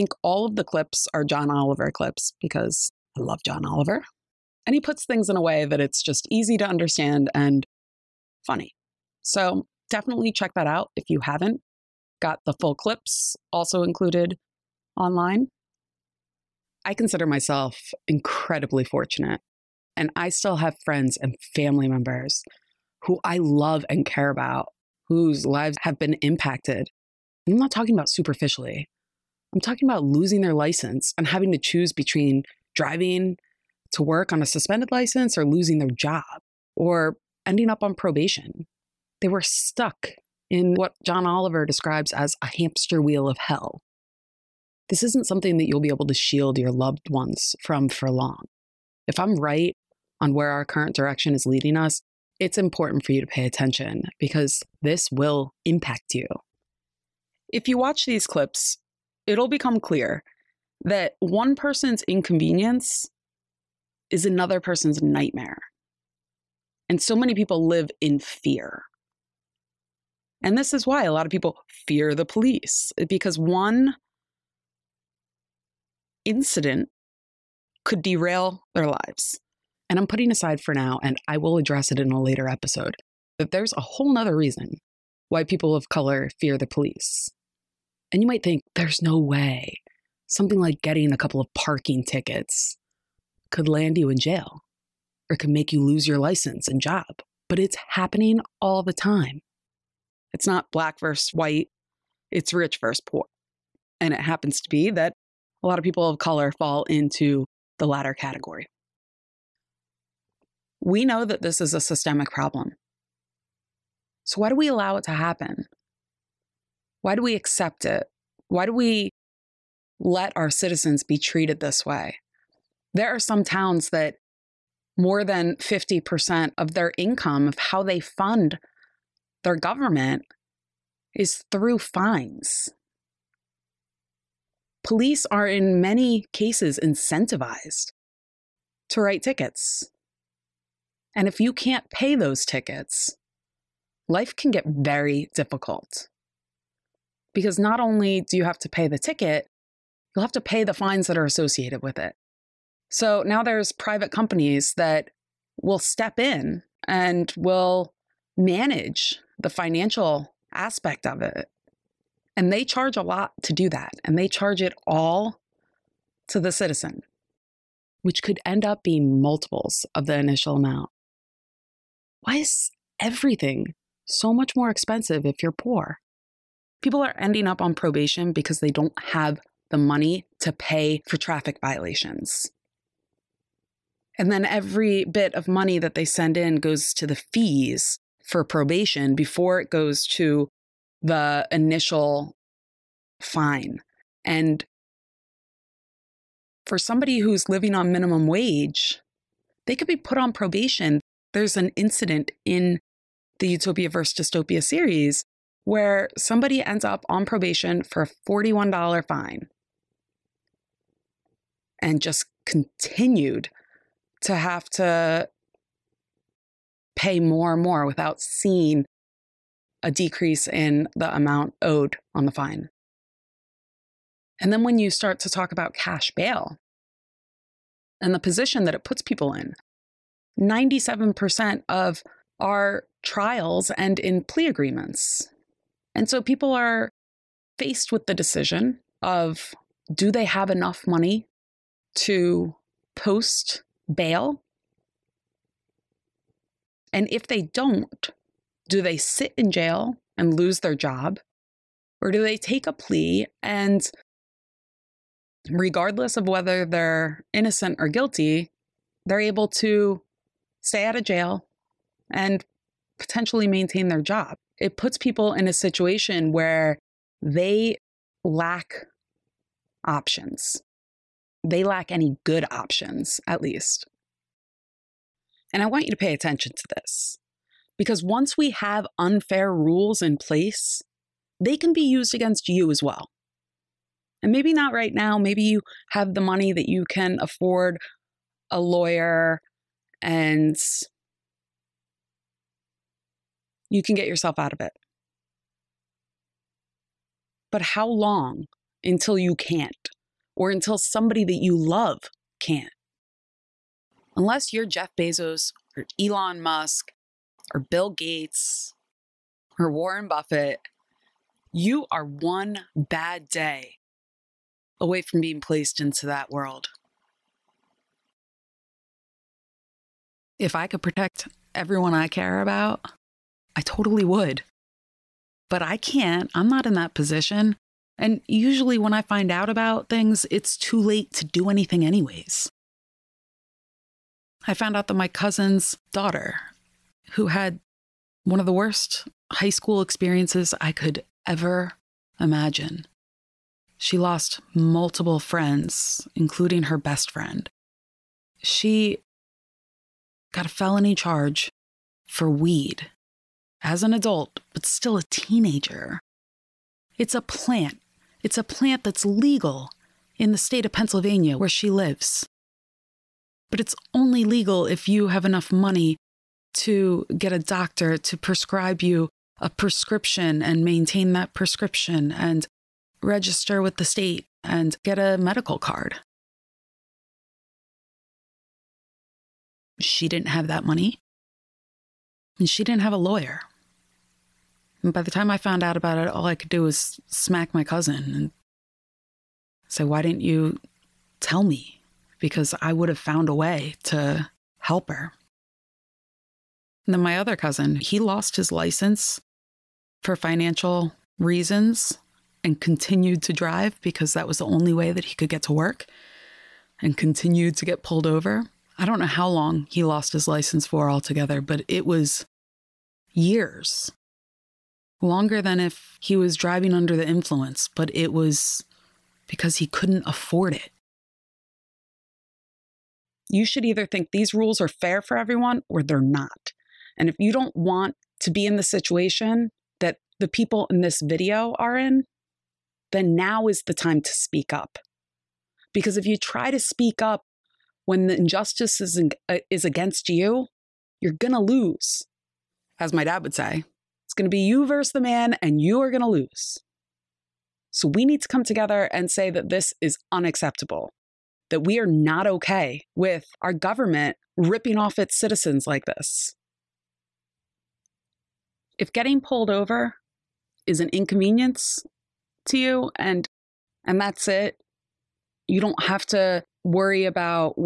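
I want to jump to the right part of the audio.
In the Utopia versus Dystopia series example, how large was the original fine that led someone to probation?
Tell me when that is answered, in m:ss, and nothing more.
3:28.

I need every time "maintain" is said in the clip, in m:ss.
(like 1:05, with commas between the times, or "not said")
4:23, 6:10.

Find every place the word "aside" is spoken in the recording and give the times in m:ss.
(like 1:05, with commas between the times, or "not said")
1:20.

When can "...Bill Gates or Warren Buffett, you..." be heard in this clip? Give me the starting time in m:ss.
5:07.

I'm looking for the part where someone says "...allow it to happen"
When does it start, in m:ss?
1:54.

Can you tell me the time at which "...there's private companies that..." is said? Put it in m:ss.
2:33.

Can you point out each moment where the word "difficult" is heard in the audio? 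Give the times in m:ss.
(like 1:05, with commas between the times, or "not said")
2:25.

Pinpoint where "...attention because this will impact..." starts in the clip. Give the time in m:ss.
0:53.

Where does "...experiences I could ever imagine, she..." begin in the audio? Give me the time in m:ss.
5:39.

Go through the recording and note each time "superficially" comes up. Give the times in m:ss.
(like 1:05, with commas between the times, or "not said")
0:28.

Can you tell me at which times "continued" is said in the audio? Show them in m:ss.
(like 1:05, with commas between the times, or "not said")
3:32, 6:42, 6:46.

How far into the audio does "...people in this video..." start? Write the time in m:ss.
7:10.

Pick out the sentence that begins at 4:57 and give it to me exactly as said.
But how long until you can't, or until somebody that you love can't?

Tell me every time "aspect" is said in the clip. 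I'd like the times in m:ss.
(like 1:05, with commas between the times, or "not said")
2:40.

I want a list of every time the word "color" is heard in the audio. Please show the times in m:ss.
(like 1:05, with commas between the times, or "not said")
1:25, 1:46.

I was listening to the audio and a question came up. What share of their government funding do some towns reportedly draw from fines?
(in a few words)
more than 50%.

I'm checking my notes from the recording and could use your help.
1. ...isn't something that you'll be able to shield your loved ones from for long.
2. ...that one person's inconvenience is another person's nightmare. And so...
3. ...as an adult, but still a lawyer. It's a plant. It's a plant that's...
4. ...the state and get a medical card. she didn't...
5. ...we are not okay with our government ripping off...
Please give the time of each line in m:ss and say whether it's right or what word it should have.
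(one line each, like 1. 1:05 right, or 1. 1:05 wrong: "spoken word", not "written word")
1. 0:45 right
2. 1:00 right
3. 5:53 wrong: "teenager", not "lawyer"
4. 6:13 right
5. 7:31 right.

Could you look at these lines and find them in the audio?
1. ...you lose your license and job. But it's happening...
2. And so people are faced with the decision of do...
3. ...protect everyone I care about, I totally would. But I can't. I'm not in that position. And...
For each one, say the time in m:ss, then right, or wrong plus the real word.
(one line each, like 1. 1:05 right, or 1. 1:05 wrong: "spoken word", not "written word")
1. 1:35 right
2. 3:55 right
3. 5:20 right.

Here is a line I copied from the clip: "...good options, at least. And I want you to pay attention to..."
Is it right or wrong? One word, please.
right.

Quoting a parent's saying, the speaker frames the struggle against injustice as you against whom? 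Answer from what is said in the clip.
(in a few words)
the man.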